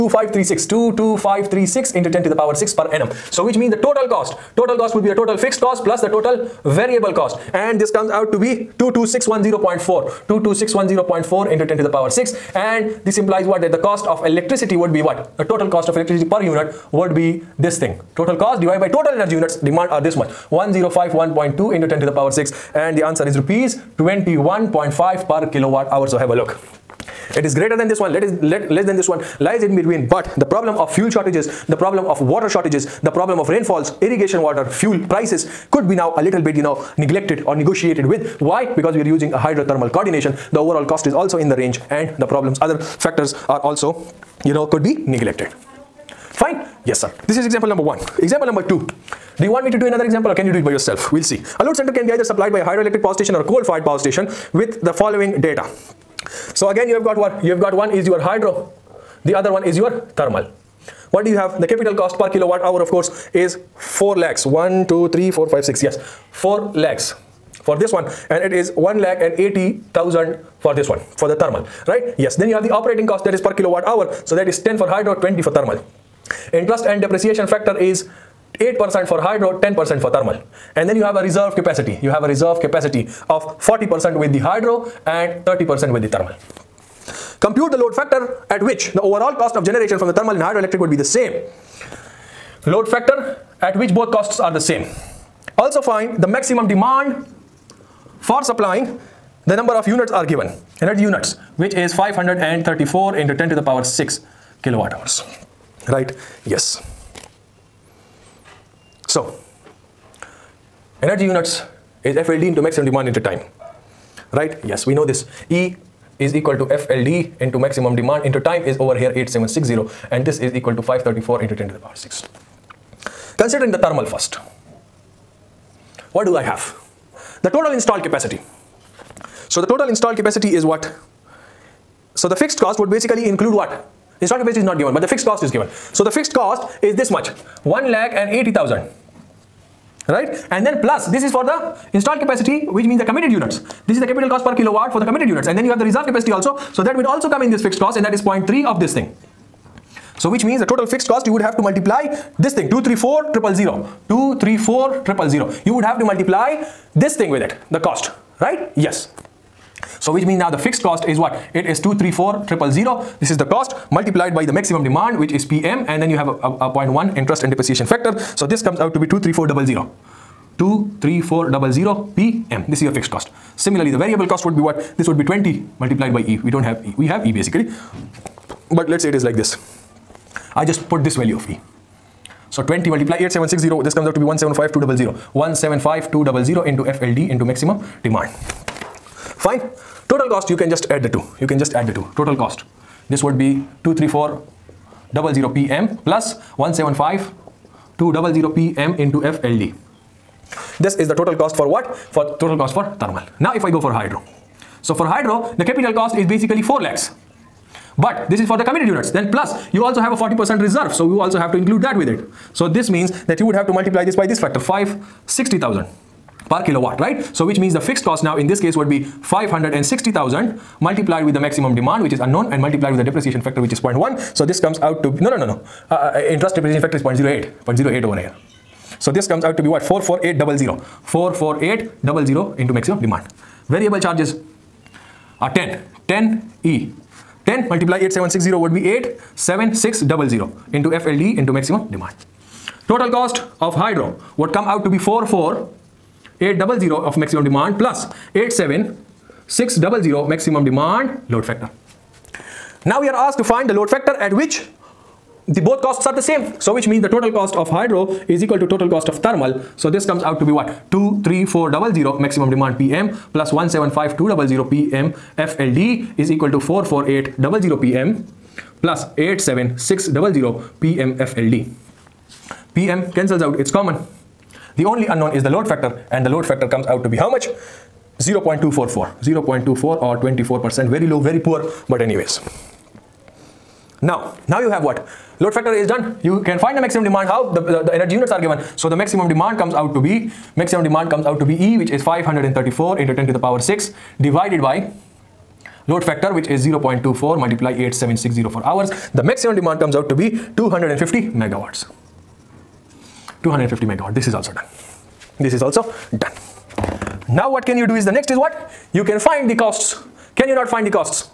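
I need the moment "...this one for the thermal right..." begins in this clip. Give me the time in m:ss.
1:10.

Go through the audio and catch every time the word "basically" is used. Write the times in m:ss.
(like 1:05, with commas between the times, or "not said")
2:12, 2:57, 3:26.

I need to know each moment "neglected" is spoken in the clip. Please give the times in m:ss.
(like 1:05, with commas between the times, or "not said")
0:36, 0:45.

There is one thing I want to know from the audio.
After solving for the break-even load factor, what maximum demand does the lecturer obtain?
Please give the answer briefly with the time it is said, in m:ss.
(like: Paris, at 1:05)
250 MW, at 5:00.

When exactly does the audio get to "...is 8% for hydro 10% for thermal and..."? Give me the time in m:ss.
1:17.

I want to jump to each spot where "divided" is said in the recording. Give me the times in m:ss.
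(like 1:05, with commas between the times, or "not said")
0:18, 4:54.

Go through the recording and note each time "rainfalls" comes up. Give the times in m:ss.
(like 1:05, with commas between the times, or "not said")
0:33.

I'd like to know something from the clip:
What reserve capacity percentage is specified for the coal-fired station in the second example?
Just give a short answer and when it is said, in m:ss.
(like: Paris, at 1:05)
30%, at 1:25.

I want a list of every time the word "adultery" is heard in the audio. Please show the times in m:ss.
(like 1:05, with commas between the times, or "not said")
not said.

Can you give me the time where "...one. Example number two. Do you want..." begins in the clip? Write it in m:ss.
0:47.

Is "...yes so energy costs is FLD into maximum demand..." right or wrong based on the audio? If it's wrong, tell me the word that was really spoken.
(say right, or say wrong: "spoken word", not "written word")
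wrong: "units", not "costs".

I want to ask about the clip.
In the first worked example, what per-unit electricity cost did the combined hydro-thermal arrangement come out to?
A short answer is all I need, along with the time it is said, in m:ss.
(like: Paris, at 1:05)
Rs 21.5 per kWh, at 0:23.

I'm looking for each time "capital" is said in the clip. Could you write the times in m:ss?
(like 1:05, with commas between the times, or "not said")
1:01, 2:24, 3:25.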